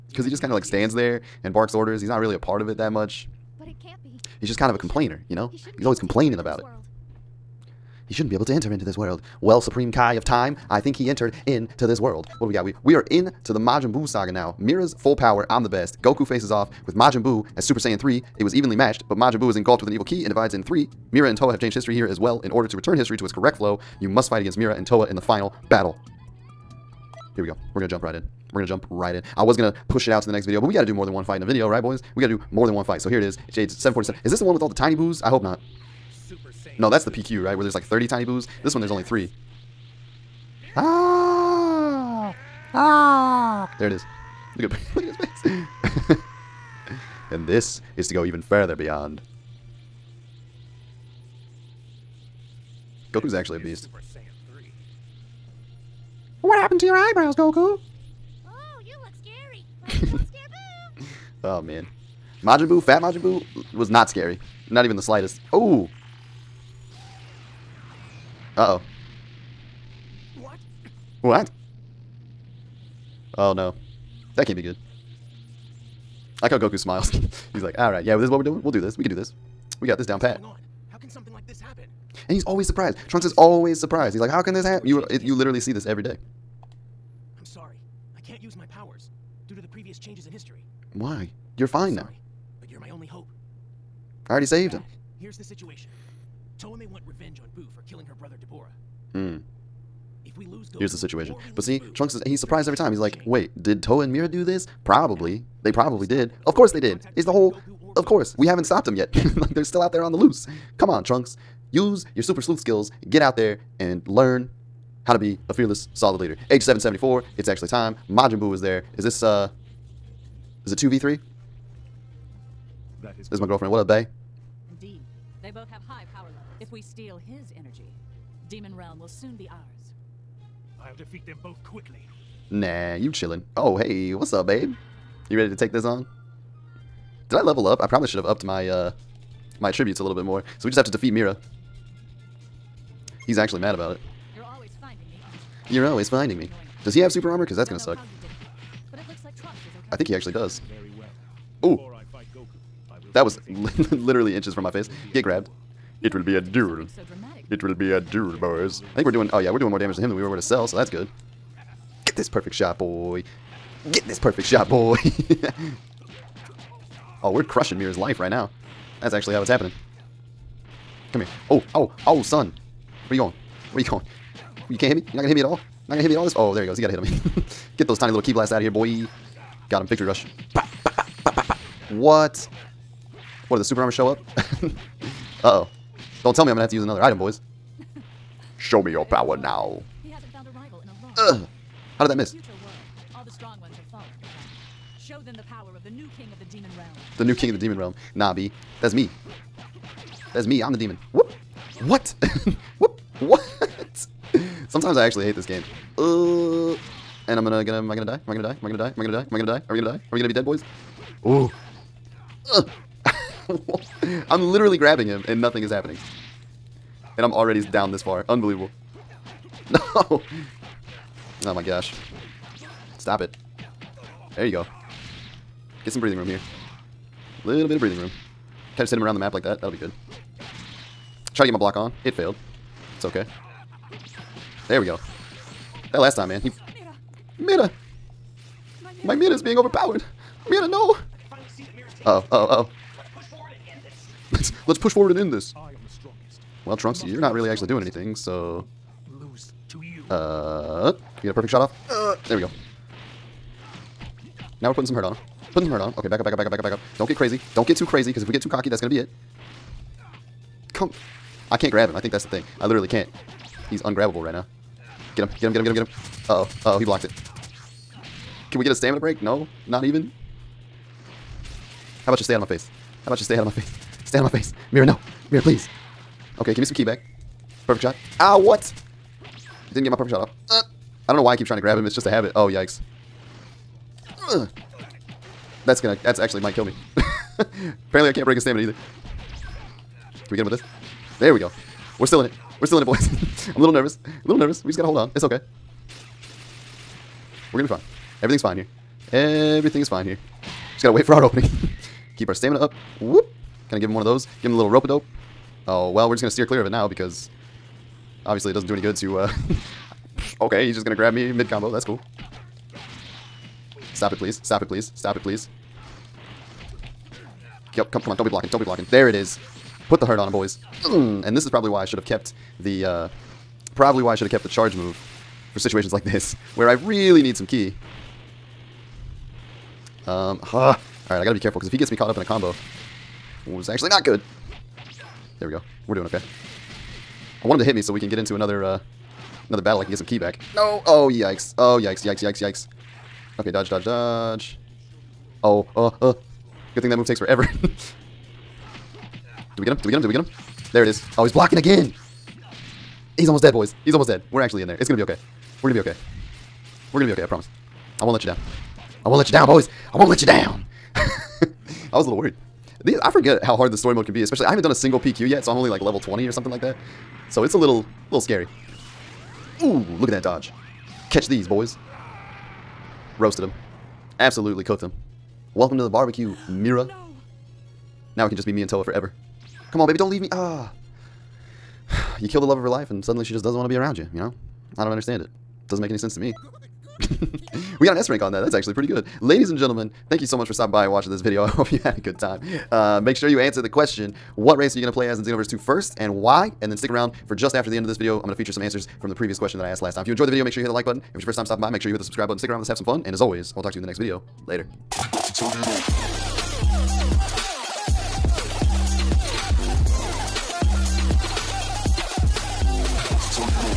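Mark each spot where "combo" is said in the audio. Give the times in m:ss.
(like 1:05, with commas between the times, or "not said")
5:11, 5:32.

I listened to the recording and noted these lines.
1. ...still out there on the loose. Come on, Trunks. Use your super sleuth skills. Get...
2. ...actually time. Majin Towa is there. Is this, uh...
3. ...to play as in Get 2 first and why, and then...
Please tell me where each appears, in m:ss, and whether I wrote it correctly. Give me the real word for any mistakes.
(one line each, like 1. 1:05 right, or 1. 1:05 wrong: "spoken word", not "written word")
1. 1:49 right
2. 1:57 wrong: "Buu", not "Towa"
3. 6:34 wrong: "Xenoverse", not "Get".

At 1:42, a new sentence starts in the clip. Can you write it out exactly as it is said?
He's like, "Wait, did Towa and Mira do this?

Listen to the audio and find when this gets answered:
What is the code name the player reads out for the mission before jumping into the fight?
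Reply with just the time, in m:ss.
0:33.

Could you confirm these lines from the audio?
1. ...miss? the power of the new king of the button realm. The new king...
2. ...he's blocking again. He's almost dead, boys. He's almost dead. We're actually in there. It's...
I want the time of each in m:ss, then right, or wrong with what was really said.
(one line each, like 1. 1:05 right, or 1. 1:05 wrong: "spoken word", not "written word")
1. 3:12 wrong: "demon", not "button"
2. 5:51 right.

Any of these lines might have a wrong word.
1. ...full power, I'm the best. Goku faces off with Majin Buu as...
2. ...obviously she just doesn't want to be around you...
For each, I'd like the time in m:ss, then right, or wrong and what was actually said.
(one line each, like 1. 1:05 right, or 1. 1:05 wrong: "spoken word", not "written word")
1. 0:14 right
2. 6:23 wrong: "suddenly", not "obviously".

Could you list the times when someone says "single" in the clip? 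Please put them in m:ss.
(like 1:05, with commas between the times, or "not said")
6:04.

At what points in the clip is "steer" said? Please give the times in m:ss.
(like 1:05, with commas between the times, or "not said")
5:06.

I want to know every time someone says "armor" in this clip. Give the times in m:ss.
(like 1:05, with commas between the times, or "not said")
2:27, 3:03.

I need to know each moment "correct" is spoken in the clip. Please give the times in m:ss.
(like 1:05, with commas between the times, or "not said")
0:23.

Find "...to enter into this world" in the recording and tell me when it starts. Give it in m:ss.
0:08.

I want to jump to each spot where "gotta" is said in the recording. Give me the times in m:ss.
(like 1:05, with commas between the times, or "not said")
4:54, 5:00, 5:31.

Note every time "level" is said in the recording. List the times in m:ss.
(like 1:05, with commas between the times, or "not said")
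2:06, 2:17, 6:05.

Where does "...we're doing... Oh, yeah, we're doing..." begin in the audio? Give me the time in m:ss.
2:39.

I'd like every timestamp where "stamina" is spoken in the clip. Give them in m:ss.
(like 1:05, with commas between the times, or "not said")
4:28, 4:48, 5:02.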